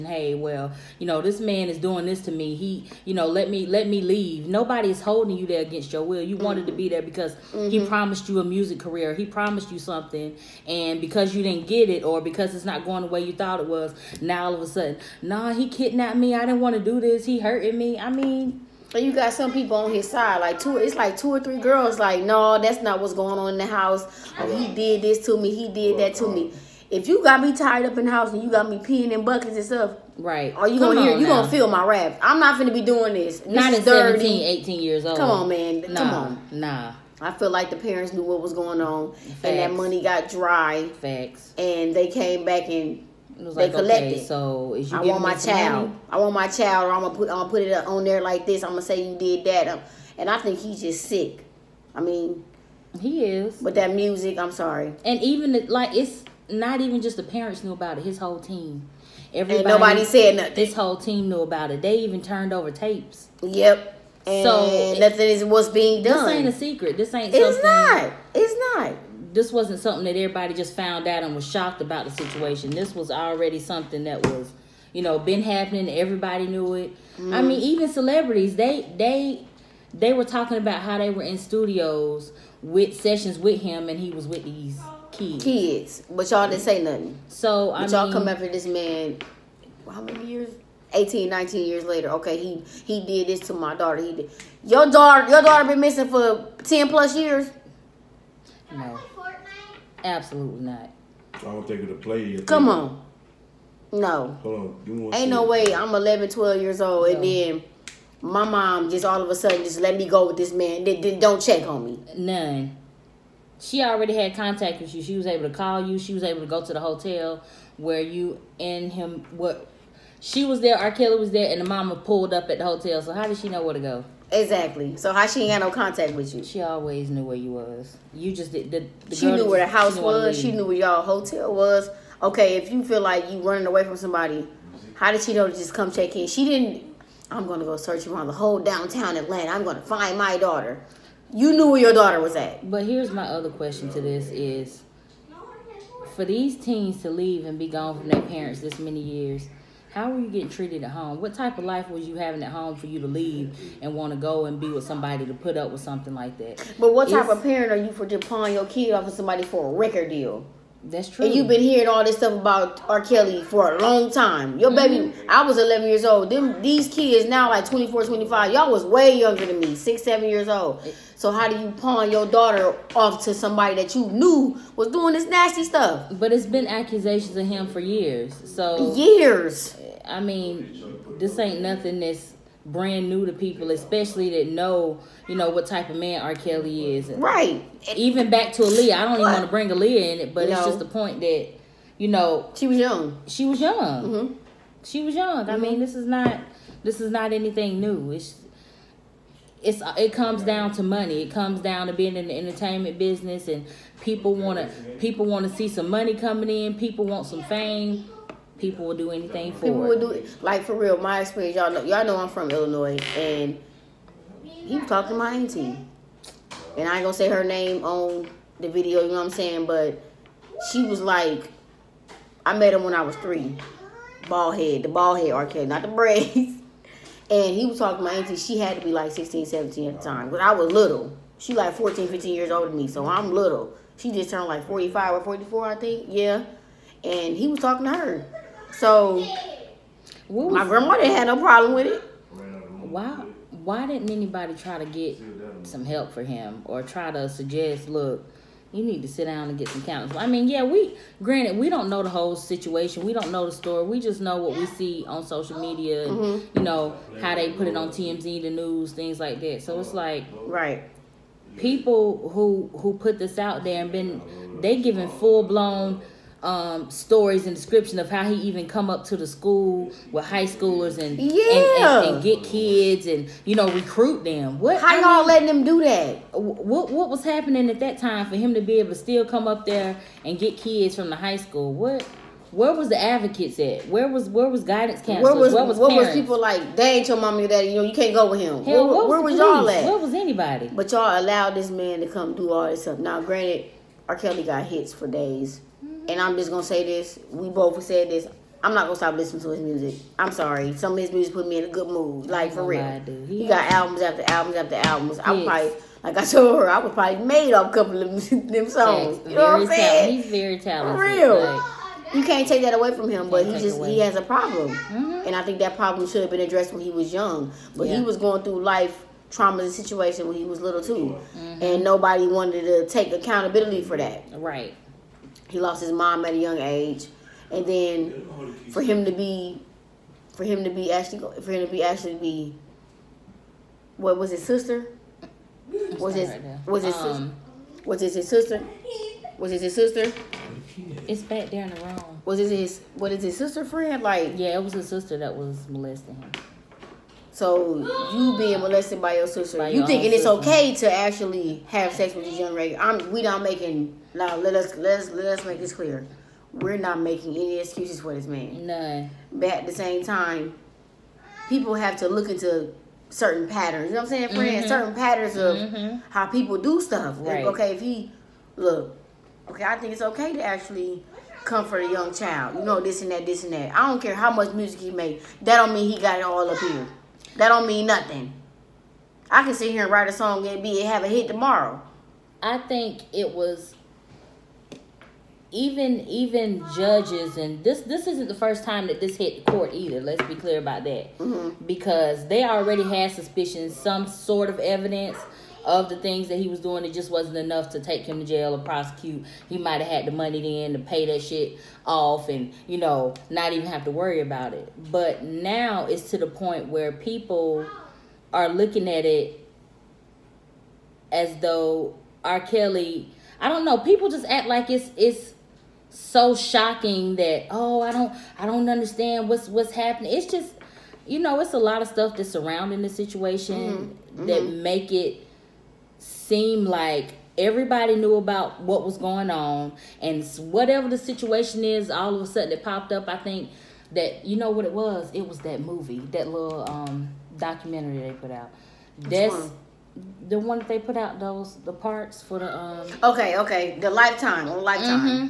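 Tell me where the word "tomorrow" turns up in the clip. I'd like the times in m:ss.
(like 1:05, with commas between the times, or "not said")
6:21.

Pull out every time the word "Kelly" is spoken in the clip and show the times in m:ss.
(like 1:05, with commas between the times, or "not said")
2:00, 2:42, 3:06, 3:45, 4:54, 6:52.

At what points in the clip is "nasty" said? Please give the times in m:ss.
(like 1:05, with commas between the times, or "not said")
2:55.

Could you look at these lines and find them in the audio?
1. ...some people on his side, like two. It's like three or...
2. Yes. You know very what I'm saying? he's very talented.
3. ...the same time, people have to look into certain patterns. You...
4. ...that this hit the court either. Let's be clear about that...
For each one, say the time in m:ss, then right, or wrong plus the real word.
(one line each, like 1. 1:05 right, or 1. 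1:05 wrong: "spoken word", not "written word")
1. 0:19 wrong: "two", not "three"
2. 5:09 right
3. 5:59 right
4. 6:28 right.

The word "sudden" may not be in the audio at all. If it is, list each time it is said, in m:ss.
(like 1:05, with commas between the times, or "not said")
0:14, 1:49, 7:12.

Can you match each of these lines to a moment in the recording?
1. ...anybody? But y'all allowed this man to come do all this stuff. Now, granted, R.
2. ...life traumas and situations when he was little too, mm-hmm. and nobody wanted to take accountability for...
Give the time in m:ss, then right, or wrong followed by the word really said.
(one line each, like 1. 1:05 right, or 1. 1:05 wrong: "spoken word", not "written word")
1. 4:50 right
2. 5:18 right.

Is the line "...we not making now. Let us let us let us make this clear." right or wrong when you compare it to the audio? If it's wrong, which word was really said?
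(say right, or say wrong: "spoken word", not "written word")
right.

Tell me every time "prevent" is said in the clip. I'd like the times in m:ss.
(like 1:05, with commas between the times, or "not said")
not said.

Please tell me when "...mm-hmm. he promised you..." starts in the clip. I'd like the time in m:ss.
0:07.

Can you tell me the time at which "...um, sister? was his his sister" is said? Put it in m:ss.
5:36.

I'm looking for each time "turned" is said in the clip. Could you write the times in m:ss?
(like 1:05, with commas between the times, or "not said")
1:02, 3:54.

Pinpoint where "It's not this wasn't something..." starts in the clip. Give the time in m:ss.
1:08.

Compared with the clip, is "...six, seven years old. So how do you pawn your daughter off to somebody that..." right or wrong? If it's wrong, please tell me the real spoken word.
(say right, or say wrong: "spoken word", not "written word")
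right.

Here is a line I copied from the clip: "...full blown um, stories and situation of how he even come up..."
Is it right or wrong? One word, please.
wrong.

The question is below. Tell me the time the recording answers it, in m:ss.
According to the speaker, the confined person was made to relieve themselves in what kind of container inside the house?
0:29.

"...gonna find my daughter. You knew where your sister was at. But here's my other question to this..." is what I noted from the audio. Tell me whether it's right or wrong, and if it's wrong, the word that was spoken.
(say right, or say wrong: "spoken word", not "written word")
wrong: "daughter", not "sister".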